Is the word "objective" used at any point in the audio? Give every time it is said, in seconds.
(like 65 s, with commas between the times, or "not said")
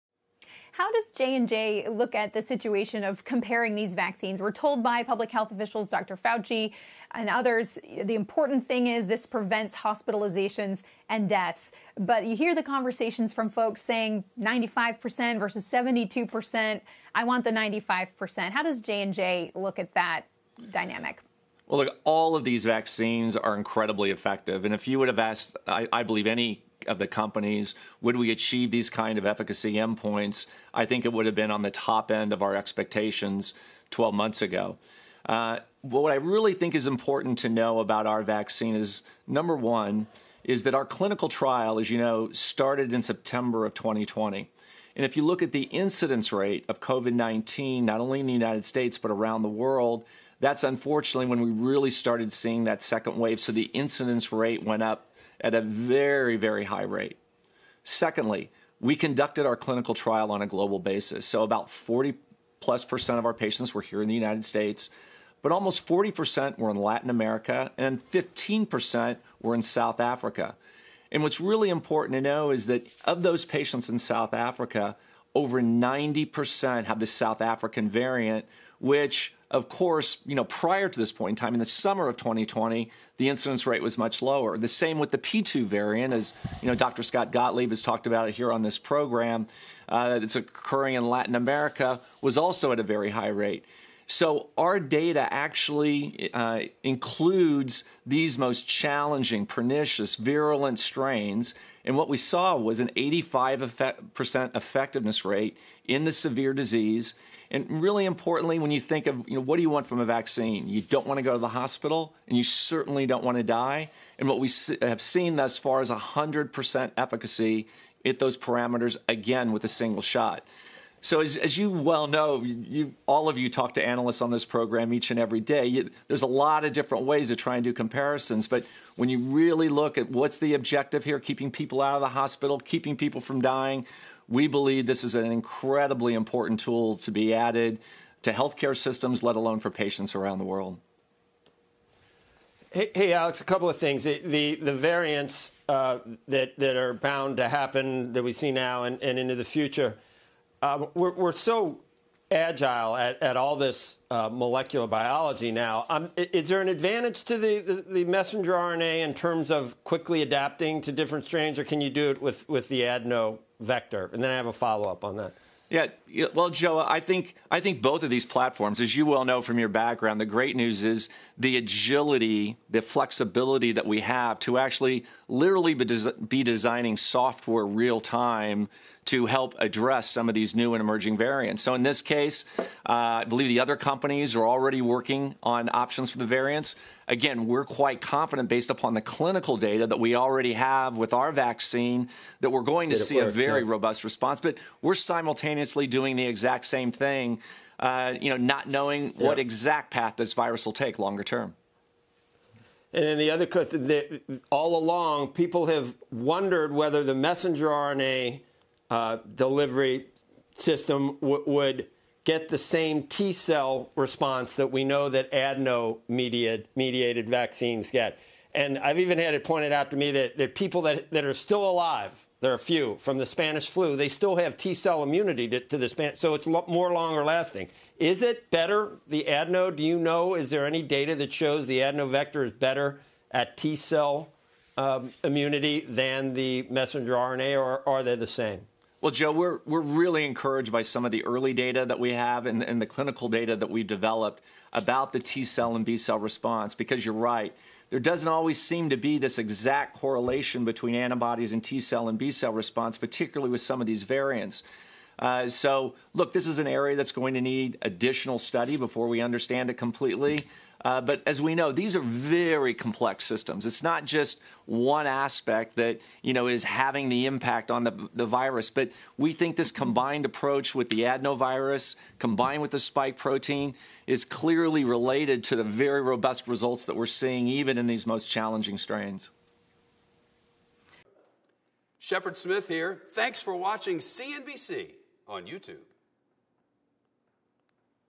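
130 s.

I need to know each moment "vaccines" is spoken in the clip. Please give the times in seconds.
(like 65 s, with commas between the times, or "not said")
3 s, 22 s, 38 s, 110 s, 191 s, 217 s.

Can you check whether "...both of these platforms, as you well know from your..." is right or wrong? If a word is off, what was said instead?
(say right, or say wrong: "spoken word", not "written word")
right.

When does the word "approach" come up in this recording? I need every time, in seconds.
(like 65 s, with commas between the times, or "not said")
270 s.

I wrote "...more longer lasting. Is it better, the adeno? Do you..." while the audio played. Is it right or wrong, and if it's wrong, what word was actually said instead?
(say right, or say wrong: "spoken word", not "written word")
right.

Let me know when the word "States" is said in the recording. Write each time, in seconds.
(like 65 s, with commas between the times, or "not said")
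48 s, 64 s.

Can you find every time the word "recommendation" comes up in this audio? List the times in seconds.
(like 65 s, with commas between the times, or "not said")
not said.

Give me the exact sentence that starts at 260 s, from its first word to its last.
Uh, but as we know, these are very complex systems.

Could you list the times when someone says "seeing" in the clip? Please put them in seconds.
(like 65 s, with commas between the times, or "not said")
52 s, 277 s.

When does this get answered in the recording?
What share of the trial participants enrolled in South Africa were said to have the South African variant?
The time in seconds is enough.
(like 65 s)
75 s.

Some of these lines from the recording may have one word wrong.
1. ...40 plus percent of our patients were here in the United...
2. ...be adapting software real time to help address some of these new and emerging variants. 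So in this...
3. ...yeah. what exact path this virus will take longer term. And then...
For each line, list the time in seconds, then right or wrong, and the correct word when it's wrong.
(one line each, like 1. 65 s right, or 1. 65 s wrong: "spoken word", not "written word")
1. 61 s right
2. 176 s wrong: "designing", not "adapting"
3. 199 s right.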